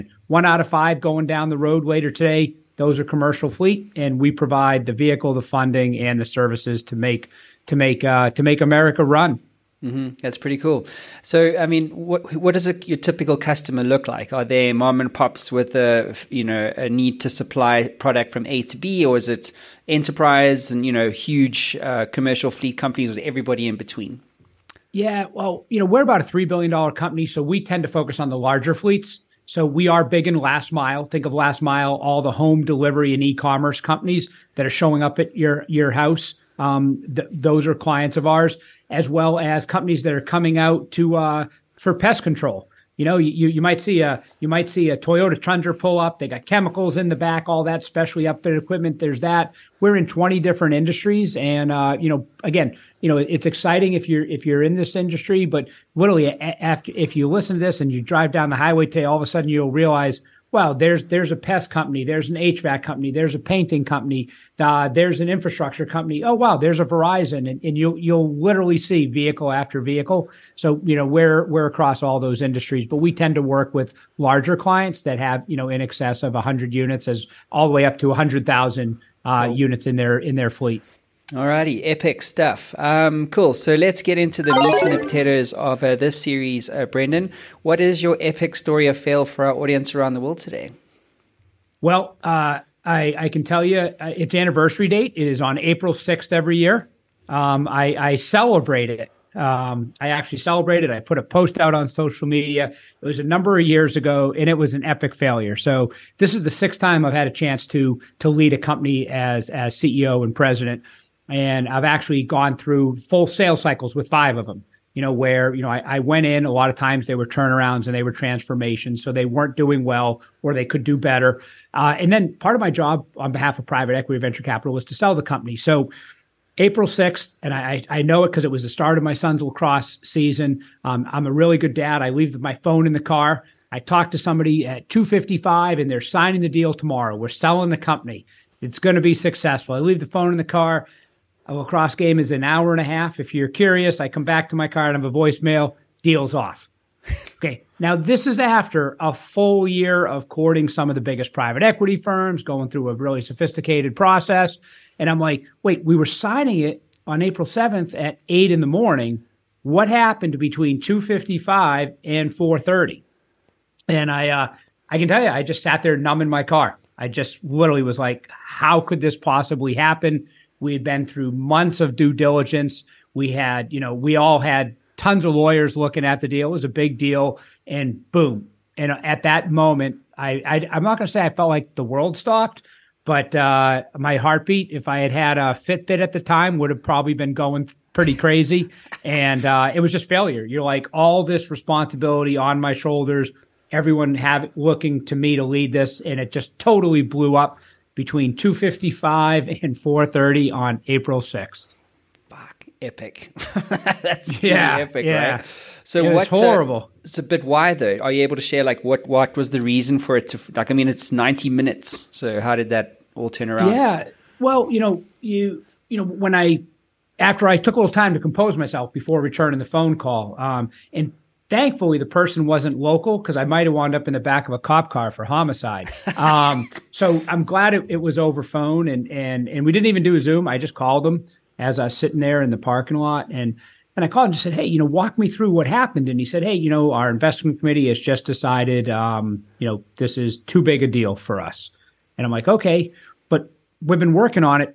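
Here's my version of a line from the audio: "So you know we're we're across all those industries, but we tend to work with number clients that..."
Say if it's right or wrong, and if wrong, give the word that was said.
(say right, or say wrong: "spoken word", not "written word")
wrong: "larger", not "number".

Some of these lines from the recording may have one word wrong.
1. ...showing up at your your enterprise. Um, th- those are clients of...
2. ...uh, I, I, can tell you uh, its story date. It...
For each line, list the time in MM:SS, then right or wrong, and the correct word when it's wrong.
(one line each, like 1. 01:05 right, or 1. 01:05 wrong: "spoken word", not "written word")
1. 00:34 wrong: "house", not "enterprise"
2. 01:32 wrong: "anniversary", not "story".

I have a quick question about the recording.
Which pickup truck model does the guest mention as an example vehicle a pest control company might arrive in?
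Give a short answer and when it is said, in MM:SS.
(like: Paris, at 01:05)
Toyota Tundra, at 00:44.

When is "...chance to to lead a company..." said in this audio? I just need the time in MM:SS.
01:47.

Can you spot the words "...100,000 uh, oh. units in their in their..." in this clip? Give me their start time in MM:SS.
01:18.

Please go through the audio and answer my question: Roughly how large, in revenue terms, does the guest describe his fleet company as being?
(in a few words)
$3 billion.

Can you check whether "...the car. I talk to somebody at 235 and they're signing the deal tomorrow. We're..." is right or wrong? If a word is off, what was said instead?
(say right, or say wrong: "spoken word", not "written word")
wrong: "255", not "235".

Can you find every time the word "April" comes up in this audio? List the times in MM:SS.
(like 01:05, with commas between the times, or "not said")
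01:35, 02:06, 02:37, 03:20.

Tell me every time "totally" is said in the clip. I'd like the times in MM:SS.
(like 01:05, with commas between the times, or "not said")
03:16.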